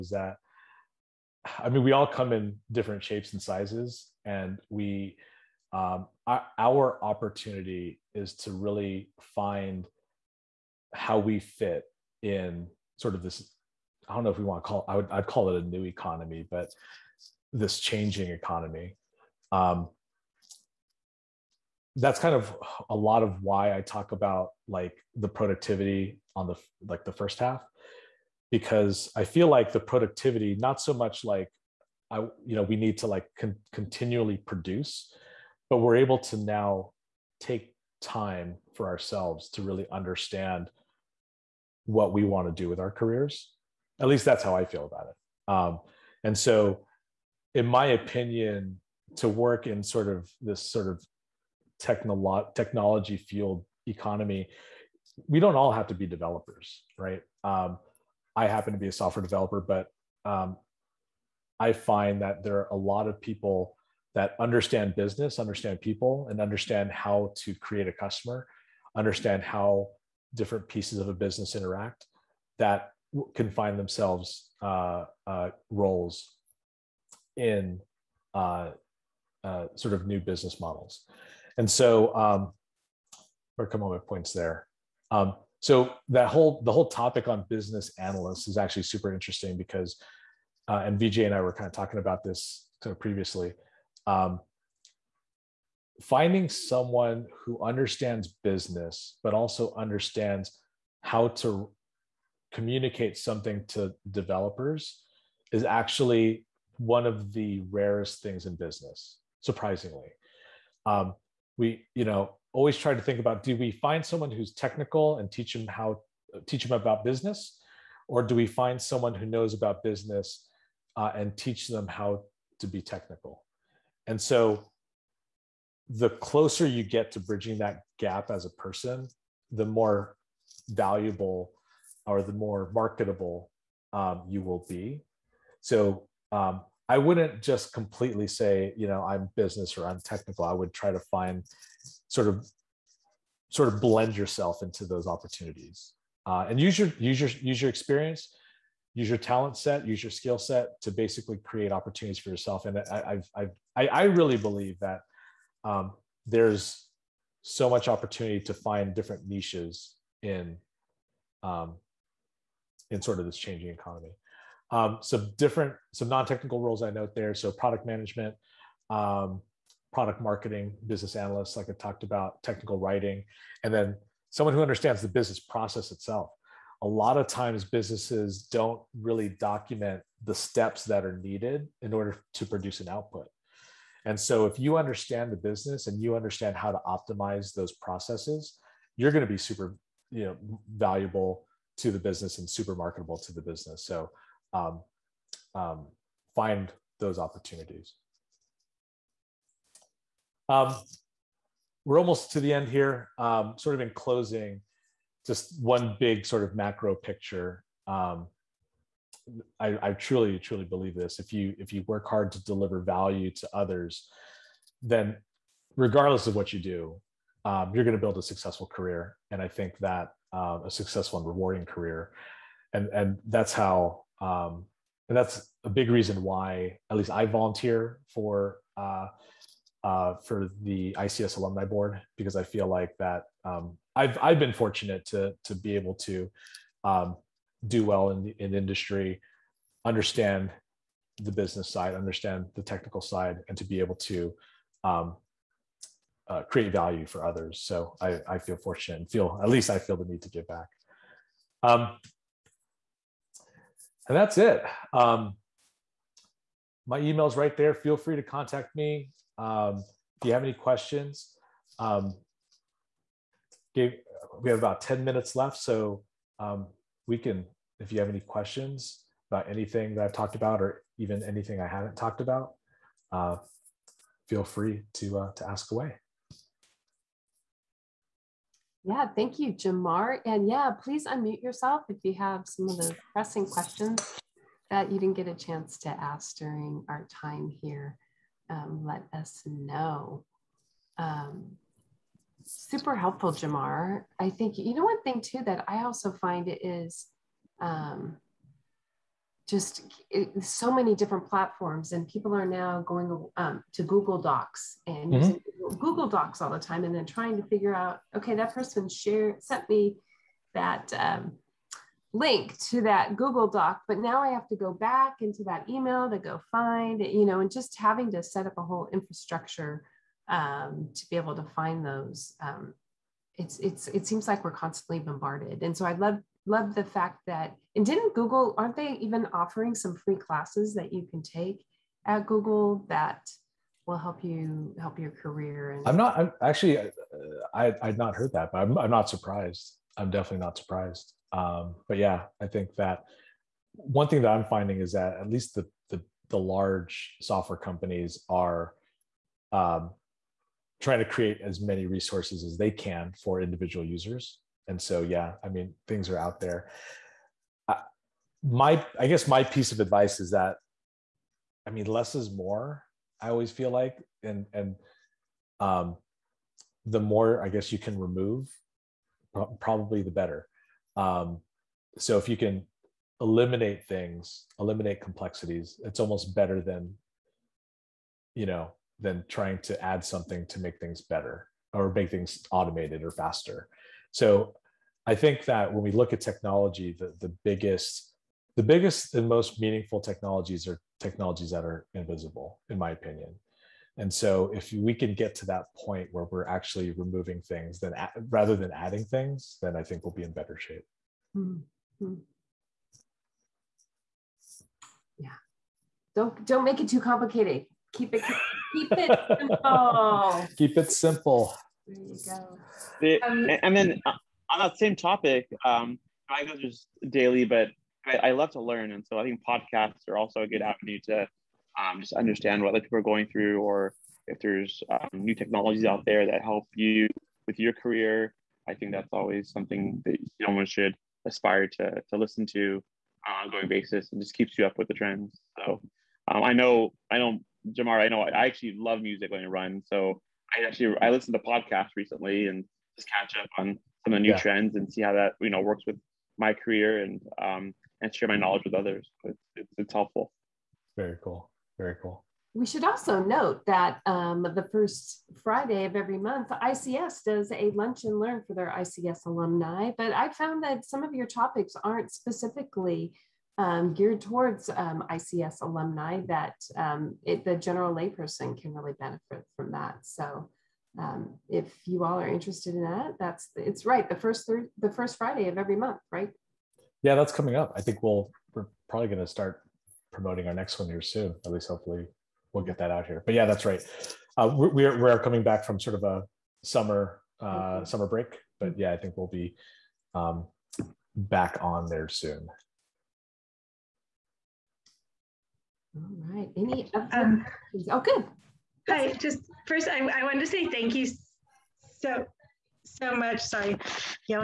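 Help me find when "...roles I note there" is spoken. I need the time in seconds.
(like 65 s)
166 s.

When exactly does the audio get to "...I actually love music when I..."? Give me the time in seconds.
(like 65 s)
438 s.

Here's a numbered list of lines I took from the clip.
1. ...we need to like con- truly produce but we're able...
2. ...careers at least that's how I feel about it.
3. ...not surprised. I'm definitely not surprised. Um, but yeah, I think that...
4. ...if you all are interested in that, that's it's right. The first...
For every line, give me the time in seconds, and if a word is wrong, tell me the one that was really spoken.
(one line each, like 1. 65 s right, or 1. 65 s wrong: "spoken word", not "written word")
1. 32 s wrong: "continually", not "truly"
2. 42 s right
3. 338 s right
4. 471 s right.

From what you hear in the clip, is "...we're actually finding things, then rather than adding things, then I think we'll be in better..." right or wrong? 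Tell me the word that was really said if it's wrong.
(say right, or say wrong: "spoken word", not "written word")
wrong: "removing", not "finding".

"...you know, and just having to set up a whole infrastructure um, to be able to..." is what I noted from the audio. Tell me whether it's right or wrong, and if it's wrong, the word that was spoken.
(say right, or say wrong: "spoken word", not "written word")
right.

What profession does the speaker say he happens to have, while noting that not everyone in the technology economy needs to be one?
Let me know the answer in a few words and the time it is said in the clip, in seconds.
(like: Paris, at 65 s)
software developer, at 58 s.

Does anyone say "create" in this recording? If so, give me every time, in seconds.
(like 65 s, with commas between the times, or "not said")
67 s, 151 s, 246 s, 351 s.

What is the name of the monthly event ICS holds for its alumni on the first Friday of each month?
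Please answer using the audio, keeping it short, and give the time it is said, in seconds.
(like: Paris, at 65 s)
lunch and learn, at 457 s.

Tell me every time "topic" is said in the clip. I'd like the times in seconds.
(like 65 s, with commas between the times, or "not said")
86 s, 414 s, 461 s.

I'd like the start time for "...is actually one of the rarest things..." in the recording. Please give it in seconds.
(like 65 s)
105 s.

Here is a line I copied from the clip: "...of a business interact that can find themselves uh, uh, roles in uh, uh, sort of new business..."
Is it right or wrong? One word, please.
right.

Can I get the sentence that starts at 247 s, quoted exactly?
So I, I feel fortunate and feel, at least I feel the need to give back.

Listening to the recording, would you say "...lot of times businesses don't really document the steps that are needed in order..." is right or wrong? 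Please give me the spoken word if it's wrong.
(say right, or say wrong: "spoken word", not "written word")
right.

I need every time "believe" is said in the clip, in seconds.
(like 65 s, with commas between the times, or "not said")
154 s, 210 s.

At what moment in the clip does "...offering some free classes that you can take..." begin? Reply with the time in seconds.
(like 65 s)
329 s.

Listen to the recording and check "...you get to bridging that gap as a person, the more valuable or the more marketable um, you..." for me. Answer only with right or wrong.
right.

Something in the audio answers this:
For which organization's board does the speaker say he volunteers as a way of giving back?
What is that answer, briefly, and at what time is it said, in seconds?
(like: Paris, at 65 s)
ICS alumni board, at 230 s.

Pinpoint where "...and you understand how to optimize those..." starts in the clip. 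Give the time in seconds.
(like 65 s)
185 s.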